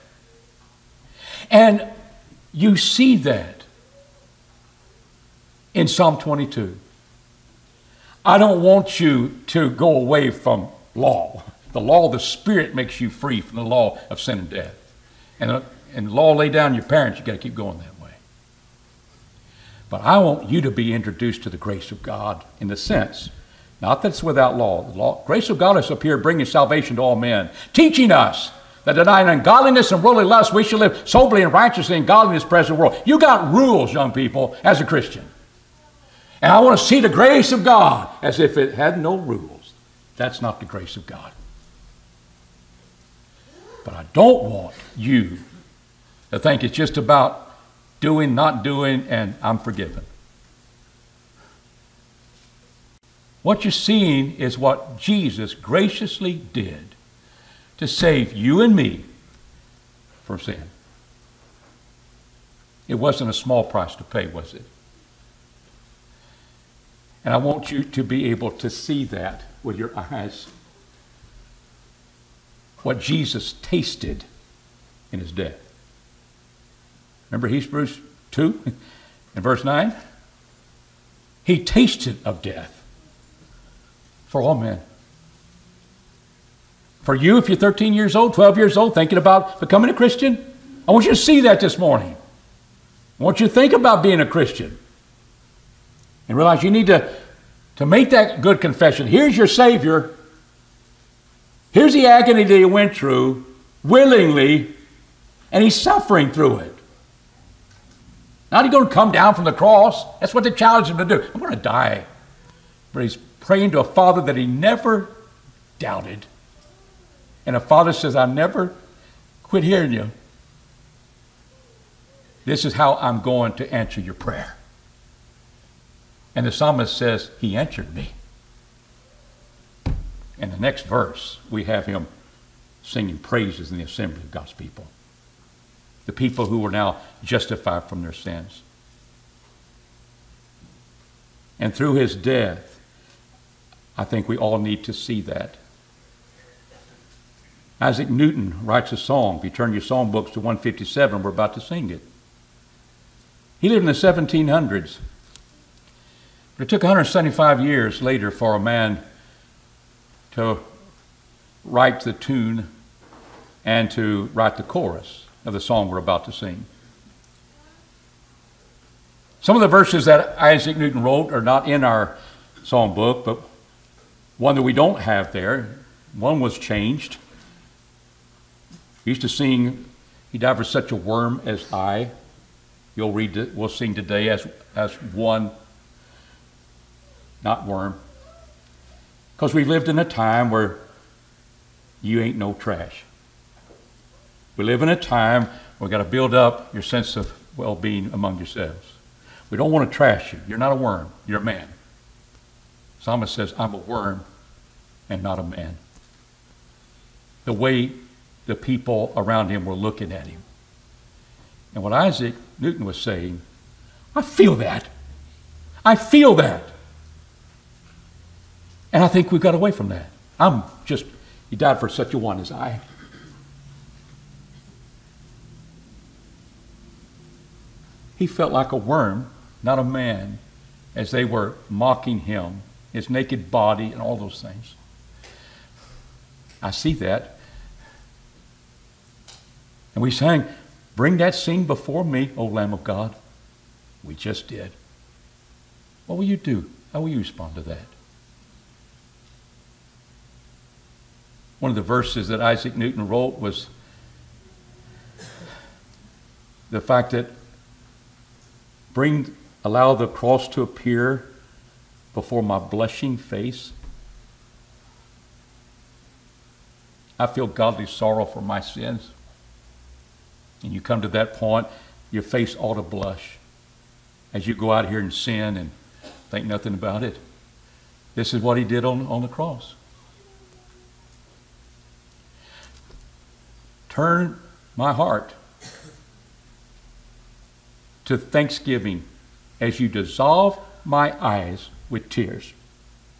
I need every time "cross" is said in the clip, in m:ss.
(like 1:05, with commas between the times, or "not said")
1:49, 4:20, 4:39.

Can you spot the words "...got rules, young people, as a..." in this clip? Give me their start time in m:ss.
0:33.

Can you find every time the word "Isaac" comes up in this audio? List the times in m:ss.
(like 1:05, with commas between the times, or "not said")
2:27, 2:50, 3:31, 4:12.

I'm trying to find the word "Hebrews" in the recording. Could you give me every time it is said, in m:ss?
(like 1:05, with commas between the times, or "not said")
1:17.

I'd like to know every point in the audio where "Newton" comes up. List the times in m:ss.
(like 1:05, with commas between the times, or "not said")
2:28, 2:50, 3:32, 4:12.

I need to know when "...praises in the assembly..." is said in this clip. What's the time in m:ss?
2:13.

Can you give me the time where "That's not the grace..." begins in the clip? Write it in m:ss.
0:40.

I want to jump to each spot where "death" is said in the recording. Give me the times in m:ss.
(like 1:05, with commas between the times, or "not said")
0:14, 1:15, 1:22, 2:22.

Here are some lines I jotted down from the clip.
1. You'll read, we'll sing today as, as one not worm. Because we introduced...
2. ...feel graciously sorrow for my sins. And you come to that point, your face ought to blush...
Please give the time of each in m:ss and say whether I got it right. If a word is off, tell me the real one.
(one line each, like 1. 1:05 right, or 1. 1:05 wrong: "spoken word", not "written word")
1. 3:02 wrong: "lived", not "introduced"
2. 4:27 wrong: "godly", not "graciously".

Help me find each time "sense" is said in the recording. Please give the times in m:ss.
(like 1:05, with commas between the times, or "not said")
0:22, 3:16.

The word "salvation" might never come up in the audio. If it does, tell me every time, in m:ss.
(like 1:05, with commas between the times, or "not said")
0:26.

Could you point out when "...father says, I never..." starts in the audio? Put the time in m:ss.
1:57.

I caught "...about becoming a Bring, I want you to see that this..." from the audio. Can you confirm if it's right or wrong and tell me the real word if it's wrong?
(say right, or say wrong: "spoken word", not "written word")
wrong: "Christian", not "Bring".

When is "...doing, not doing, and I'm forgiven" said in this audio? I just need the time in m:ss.
0:47.